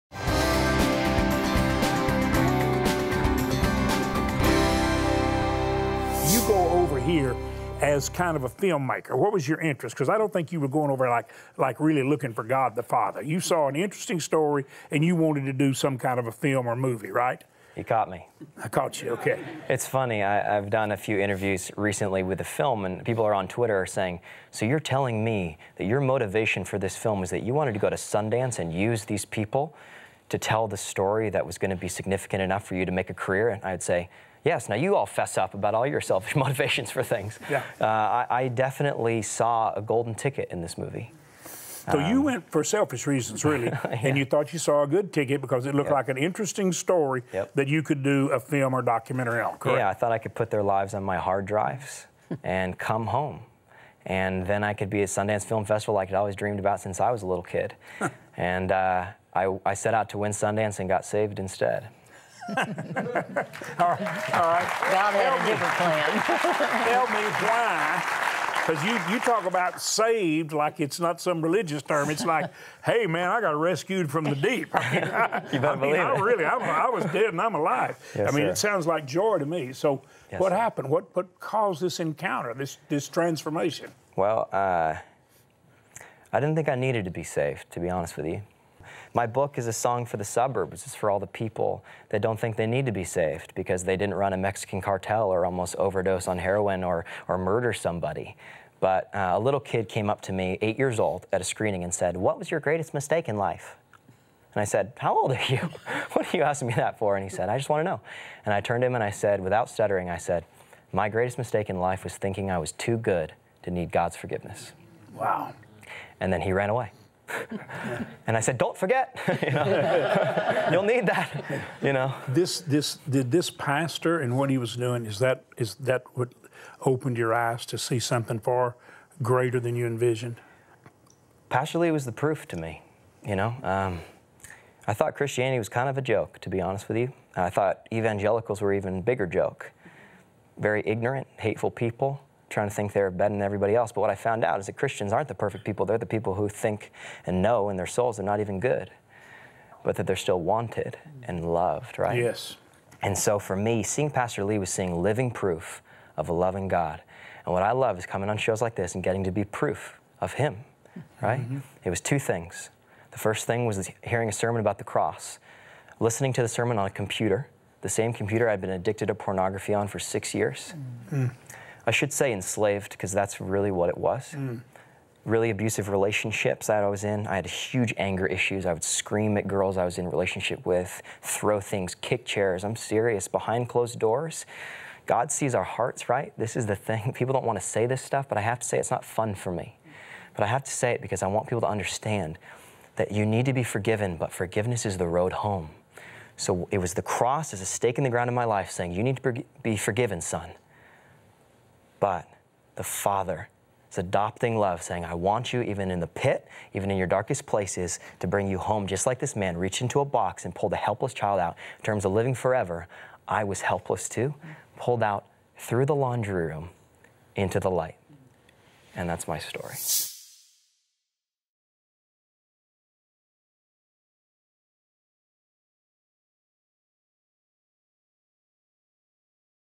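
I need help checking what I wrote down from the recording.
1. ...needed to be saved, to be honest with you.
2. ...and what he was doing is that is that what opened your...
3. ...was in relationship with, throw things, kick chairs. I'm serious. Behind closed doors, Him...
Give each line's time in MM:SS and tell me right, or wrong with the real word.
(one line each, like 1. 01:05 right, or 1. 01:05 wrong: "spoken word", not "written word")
1. 01:26 right
2. 02:04 right
3. 02:59 wrong: "God", not "Him".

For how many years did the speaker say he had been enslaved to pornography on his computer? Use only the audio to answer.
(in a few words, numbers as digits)
6.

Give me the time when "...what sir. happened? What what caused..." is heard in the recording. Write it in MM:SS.
01:20.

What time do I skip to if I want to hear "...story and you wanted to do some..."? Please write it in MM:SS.
00:14.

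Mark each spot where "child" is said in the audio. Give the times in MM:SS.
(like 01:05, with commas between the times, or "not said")
03:31.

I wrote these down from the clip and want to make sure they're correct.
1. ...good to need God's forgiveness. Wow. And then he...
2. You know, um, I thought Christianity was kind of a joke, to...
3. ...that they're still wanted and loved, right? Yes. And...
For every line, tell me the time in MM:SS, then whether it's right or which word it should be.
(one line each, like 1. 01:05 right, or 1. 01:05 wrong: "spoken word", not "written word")
1. 01:52 right
2. 02:13 right
3. 02:29 right.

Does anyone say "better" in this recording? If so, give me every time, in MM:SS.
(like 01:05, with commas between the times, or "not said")
01:15, 02:23.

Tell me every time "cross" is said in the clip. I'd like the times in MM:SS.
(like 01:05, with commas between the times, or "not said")
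02:44, 03:17.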